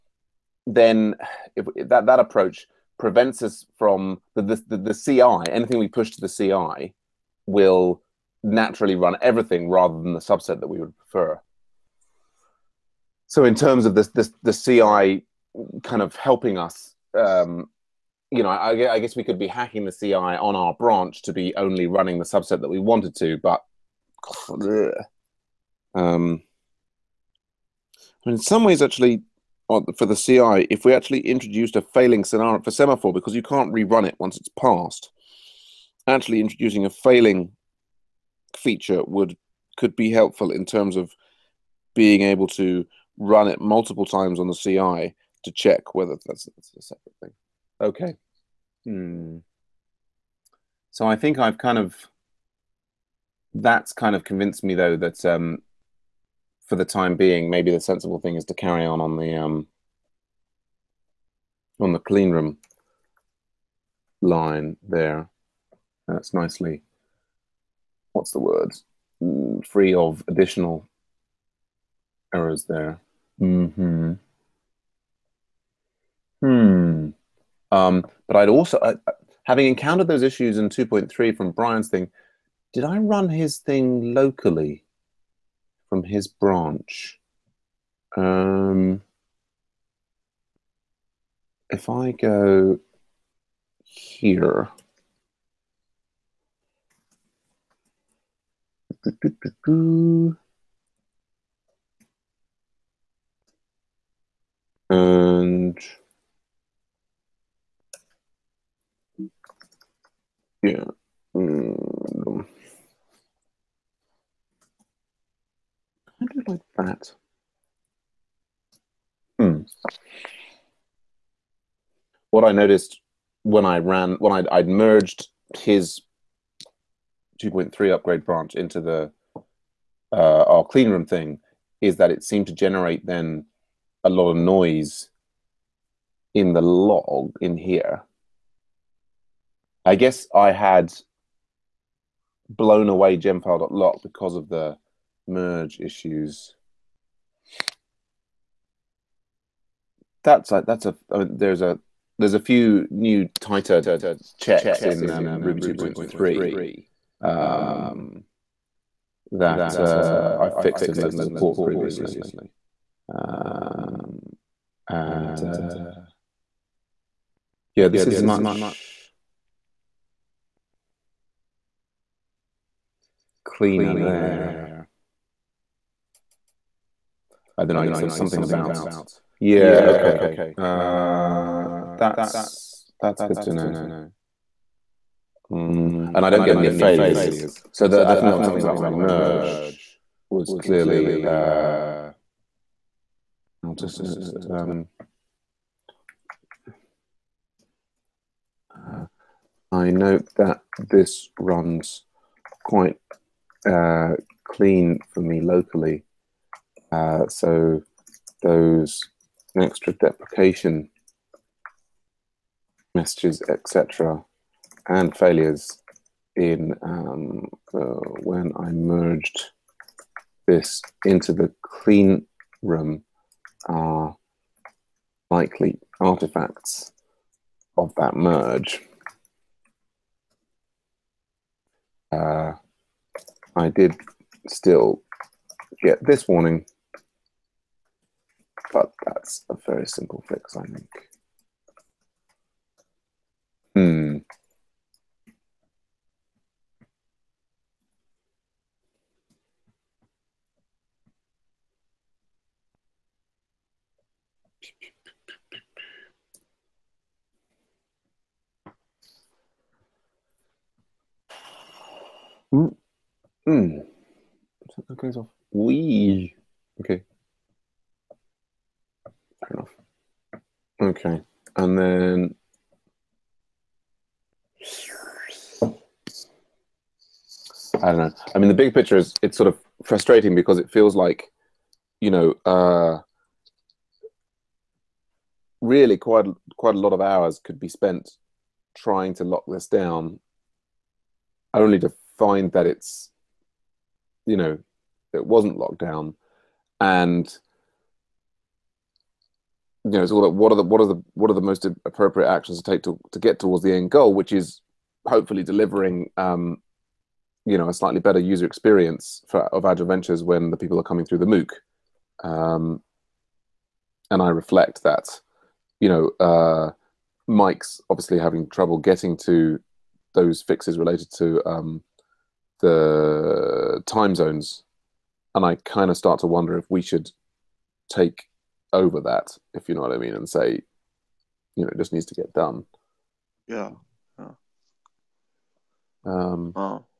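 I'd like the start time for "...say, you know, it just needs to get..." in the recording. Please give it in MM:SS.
05:30.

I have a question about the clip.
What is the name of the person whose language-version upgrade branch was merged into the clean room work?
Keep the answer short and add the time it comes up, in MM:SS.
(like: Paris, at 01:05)
Brian, at 01:21.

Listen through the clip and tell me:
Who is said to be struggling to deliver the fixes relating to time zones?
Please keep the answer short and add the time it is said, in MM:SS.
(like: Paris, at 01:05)
Mike, at 05:17.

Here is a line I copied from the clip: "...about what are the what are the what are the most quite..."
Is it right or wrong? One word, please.
wrong.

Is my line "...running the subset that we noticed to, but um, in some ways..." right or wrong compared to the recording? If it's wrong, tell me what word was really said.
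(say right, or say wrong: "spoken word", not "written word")
wrong: "wanted", not "noticed".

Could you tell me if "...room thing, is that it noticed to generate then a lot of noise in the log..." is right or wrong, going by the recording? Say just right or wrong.
wrong.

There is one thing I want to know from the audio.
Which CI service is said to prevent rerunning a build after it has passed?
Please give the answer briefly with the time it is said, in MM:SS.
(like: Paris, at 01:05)
Semaphore, at 00:32.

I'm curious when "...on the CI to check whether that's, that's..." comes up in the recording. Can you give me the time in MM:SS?
00:44.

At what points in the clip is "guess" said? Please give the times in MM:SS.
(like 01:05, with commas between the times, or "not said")
00:18, 02:19, 02:57.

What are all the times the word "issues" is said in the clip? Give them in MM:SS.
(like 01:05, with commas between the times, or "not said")
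01:20, 02:25.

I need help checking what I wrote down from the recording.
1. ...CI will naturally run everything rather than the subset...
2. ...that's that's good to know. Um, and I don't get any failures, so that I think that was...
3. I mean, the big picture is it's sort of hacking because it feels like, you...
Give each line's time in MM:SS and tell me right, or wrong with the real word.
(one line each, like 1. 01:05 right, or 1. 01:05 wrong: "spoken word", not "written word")
1. 00:06 right
2. 03:01 right
3. 04:38 wrong: "frustrating", not "hacking".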